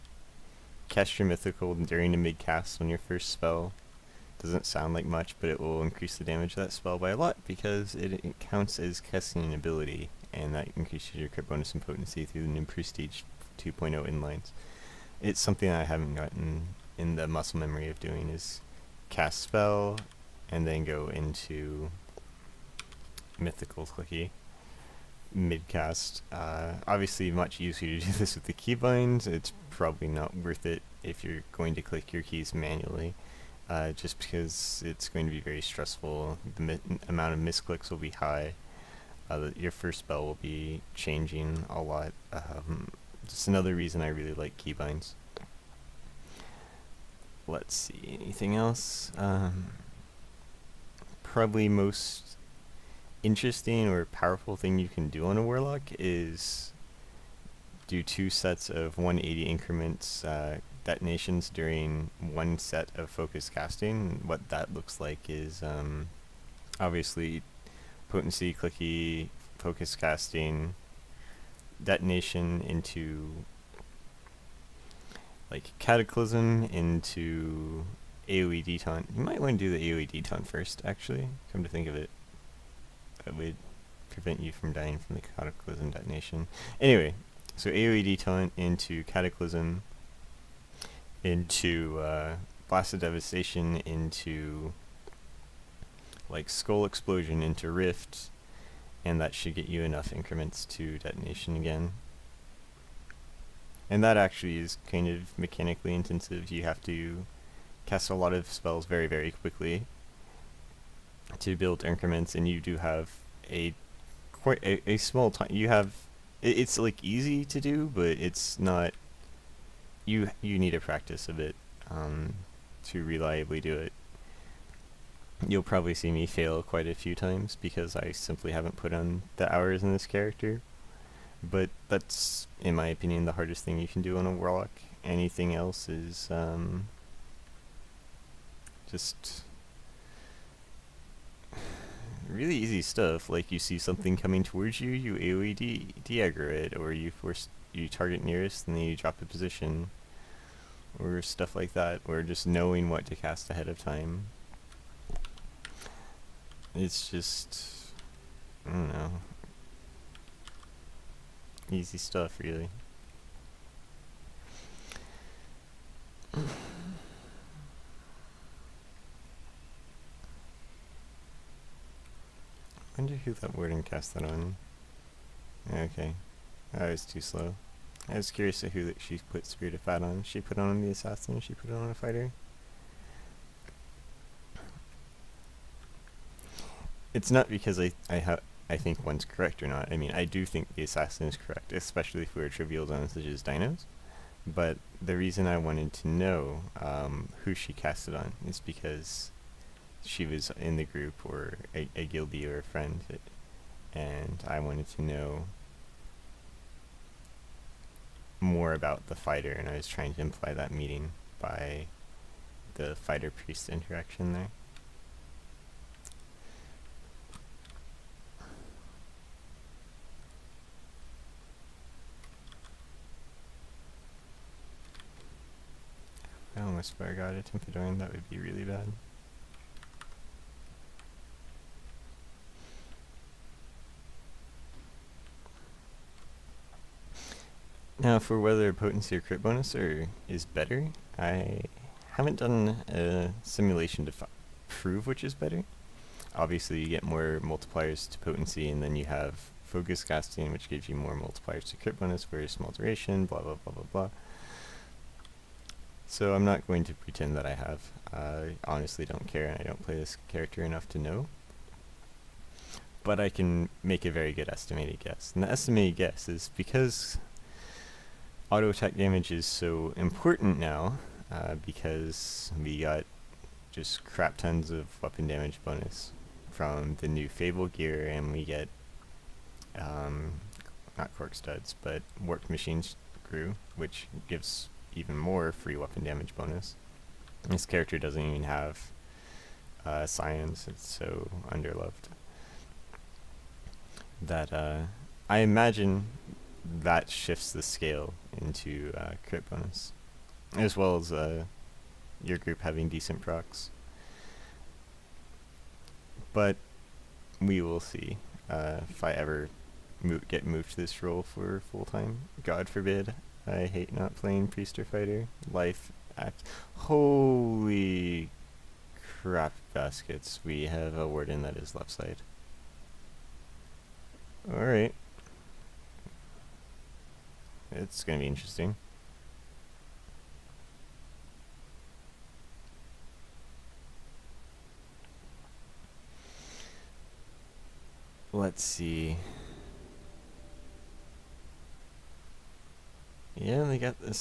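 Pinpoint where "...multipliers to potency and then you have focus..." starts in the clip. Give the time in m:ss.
4:07.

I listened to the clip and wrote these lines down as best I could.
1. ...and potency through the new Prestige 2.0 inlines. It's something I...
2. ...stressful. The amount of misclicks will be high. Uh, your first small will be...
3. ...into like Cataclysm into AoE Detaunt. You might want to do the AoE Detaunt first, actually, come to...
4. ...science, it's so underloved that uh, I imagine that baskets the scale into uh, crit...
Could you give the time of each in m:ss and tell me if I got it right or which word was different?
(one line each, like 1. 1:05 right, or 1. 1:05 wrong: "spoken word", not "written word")
1. 0:11 right
2. 0:35 wrong: "spell", not "small"
3. 1:12 right
4. 4:50 wrong: "shifts", not "baskets".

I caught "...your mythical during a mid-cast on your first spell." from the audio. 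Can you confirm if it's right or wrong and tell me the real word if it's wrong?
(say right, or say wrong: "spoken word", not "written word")
right.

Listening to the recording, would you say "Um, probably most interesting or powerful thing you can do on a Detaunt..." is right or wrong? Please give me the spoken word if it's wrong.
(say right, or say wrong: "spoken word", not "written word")
wrong: "Warlock", not "Detaunt".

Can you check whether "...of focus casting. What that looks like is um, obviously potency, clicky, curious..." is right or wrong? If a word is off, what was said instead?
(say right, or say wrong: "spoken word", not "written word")
wrong: "focus", not "curious".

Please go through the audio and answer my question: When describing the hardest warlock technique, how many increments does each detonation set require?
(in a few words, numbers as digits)
180.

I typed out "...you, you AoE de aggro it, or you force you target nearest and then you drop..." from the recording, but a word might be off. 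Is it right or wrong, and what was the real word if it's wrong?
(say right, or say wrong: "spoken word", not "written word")
right.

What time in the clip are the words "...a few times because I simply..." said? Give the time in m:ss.
2:06.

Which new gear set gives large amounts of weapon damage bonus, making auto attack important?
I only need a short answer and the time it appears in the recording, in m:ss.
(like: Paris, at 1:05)
Fable gear, at 4:37.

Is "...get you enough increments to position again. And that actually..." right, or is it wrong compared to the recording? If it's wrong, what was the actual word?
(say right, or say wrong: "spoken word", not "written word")
wrong: "detonation", not "position".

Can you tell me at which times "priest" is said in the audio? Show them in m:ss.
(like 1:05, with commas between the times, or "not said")
3:33, 5:14.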